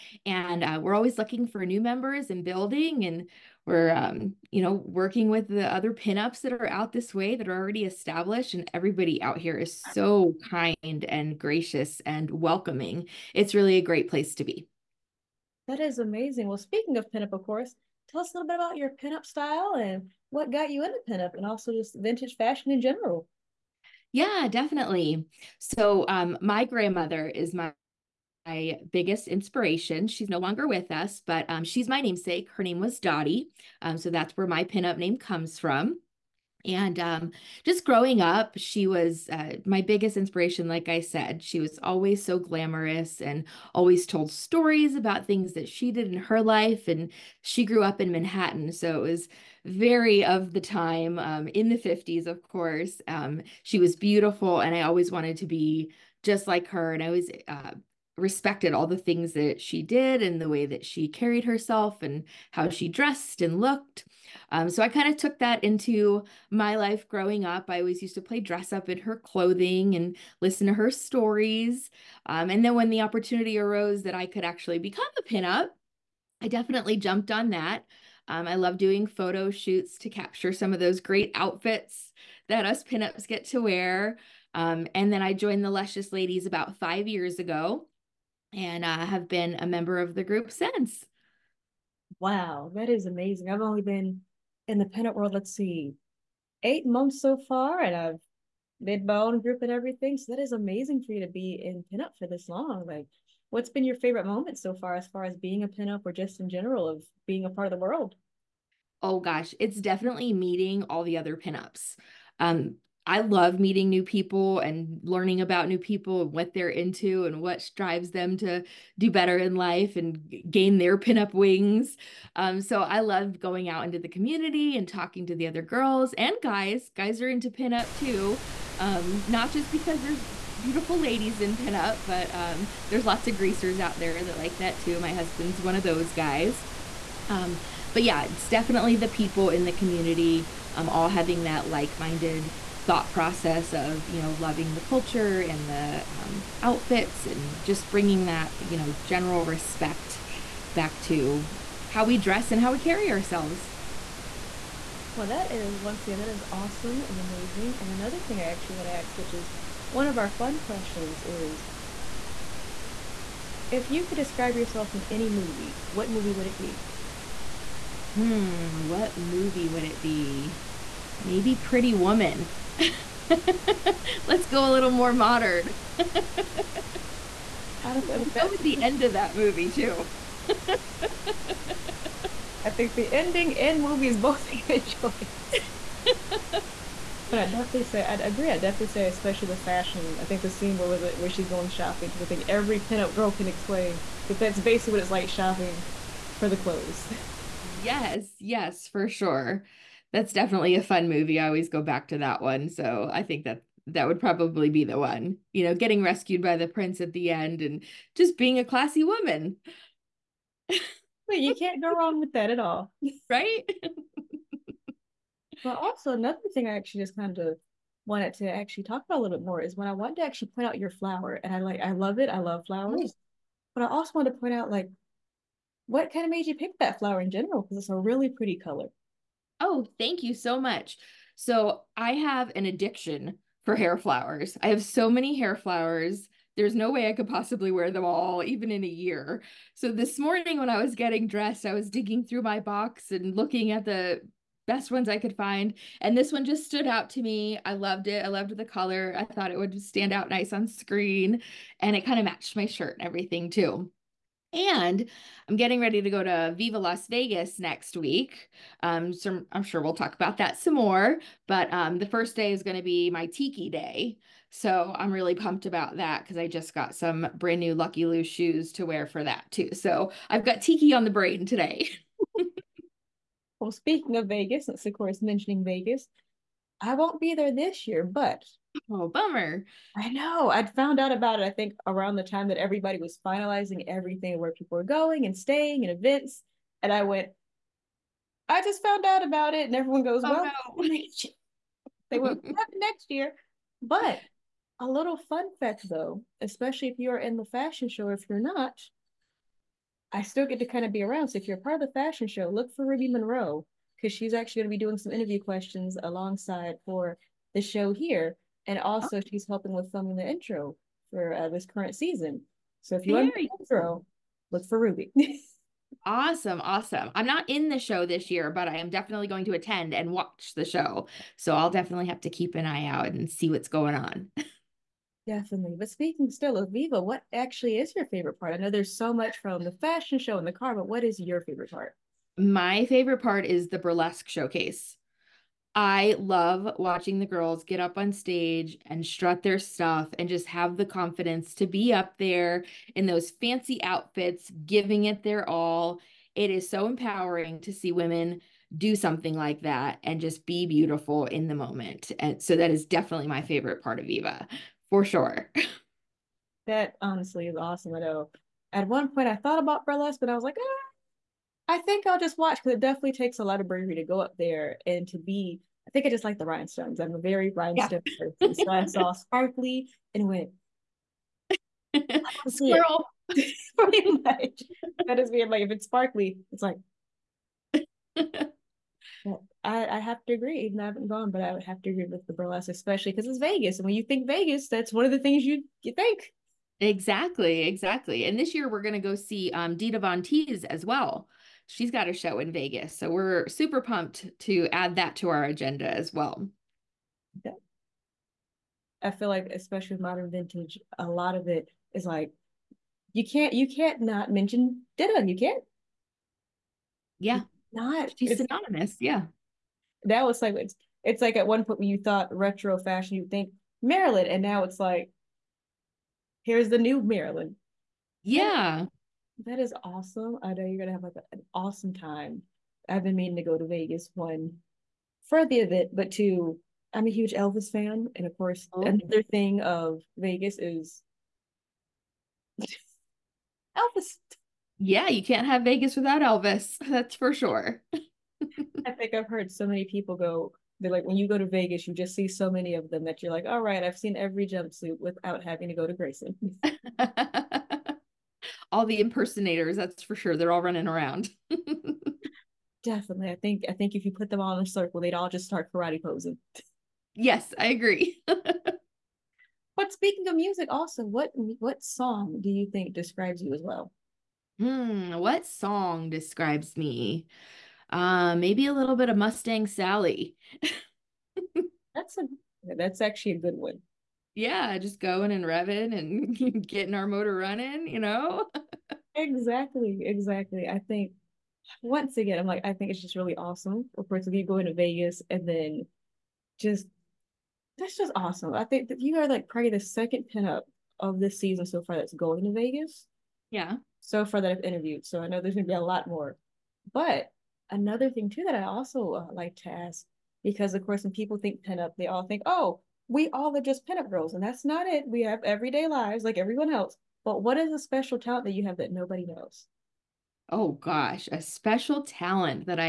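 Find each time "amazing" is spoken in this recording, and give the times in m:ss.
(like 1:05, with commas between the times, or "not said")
0:15, 1:33, 1:40, 2:37.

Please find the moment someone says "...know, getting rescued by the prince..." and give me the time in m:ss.
3:25.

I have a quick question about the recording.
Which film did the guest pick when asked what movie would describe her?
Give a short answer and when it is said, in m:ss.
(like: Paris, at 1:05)
Pretty Woman, at 2:51.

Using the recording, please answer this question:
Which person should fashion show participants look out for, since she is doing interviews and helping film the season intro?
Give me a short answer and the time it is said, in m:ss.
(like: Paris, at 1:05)
Ruby Monroe, at 5:02.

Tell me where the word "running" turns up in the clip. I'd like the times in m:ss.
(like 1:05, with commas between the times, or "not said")
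7:30, 7:57.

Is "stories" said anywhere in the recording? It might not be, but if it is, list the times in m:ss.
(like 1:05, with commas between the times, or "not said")
0:44, 1:10.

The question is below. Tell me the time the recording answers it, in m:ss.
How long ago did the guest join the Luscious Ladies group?
1:26.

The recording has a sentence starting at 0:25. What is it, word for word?
So, um, my grandmother is my my biggest inspiration.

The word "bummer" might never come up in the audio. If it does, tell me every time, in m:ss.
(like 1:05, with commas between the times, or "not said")
4:39.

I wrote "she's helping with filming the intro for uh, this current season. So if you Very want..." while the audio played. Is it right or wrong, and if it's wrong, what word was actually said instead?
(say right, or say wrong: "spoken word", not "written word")
right.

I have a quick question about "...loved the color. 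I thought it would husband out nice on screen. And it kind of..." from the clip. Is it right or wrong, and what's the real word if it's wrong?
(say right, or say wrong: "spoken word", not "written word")
wrong: "stand", not "husband".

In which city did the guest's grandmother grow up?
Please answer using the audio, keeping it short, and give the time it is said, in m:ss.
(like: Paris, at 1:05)
Manhattan, at 0:48.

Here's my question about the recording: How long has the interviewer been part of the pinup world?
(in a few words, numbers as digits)
Eight months.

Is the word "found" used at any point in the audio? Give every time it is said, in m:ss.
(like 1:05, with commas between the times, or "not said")
4:40, 4:48.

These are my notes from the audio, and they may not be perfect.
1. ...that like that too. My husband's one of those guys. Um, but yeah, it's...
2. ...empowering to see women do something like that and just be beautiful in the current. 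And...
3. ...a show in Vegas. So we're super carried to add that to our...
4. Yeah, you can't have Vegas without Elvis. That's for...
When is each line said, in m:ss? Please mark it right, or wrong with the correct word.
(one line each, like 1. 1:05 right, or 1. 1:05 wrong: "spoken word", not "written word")
1. 2:14 right
2. 5:46 wrong: "moment", not "current"
3. 6:32 wrong: "pumped", not "carried"
4. 7:14 right.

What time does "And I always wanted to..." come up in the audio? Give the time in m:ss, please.
0:54.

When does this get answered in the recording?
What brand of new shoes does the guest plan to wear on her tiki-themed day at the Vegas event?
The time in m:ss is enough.
4:27.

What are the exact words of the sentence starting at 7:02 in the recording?
I've been meaning to go to Vegas one for the event, but two, I'm a huge Elvis fan, and of course, oh.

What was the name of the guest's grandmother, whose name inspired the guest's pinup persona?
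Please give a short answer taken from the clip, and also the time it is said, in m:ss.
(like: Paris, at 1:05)
Dottie, at 0:32.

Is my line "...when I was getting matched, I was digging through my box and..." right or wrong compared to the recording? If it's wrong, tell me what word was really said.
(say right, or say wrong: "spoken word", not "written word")
wrong: "dressed", not "matched".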